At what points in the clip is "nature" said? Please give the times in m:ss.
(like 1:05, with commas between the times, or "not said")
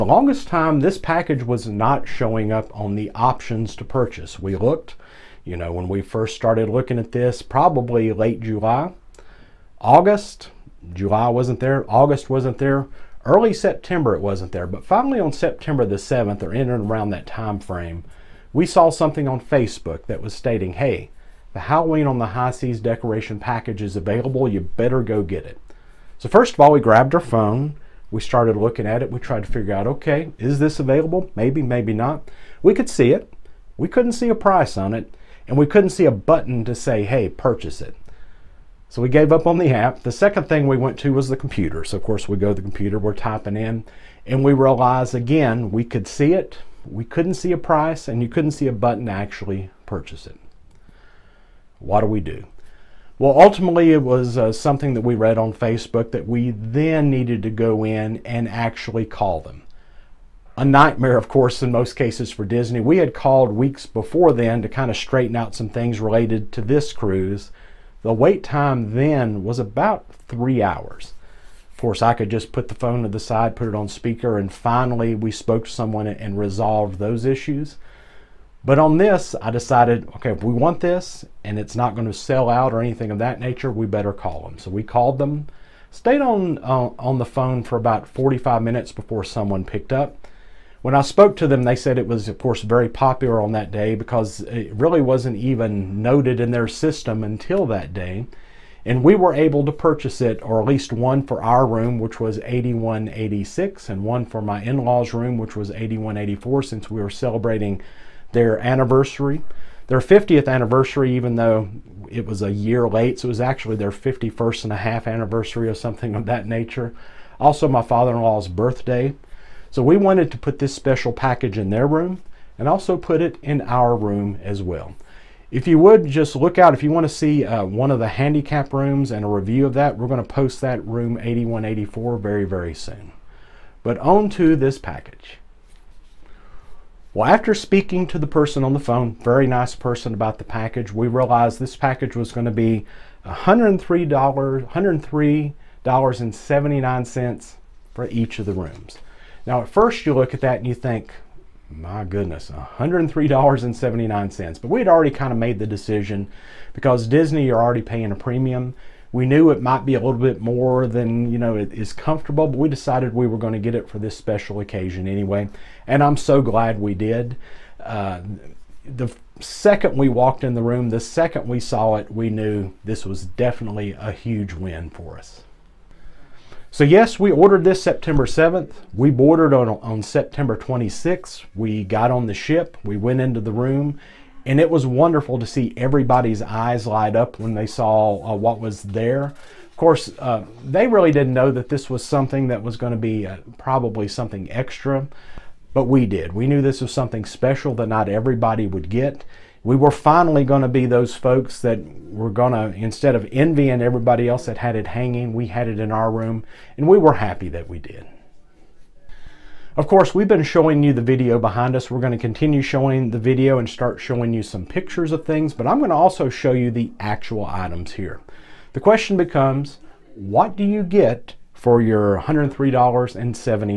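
1:23, 1:56.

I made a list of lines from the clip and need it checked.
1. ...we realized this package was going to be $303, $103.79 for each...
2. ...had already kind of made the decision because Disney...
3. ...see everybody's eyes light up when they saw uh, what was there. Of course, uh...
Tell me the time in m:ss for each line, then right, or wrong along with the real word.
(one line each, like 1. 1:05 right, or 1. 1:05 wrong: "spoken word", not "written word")
1. 2:20 wrong: "103", not "303"
2. 2:34 right
3. 3:05 right.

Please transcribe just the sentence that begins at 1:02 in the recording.
We had called weeks before then to kind of straighten out some things related to this cruise.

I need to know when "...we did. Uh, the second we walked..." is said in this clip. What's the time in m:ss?
2:46.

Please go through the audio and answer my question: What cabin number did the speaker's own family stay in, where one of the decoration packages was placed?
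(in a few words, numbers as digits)
8186.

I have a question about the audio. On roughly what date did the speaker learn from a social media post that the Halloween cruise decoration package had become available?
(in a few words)
September 7th.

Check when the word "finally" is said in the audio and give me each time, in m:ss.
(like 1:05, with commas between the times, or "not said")
0:14, 1:14, 3:19.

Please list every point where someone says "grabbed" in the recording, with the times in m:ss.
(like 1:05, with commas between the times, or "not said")
0:26.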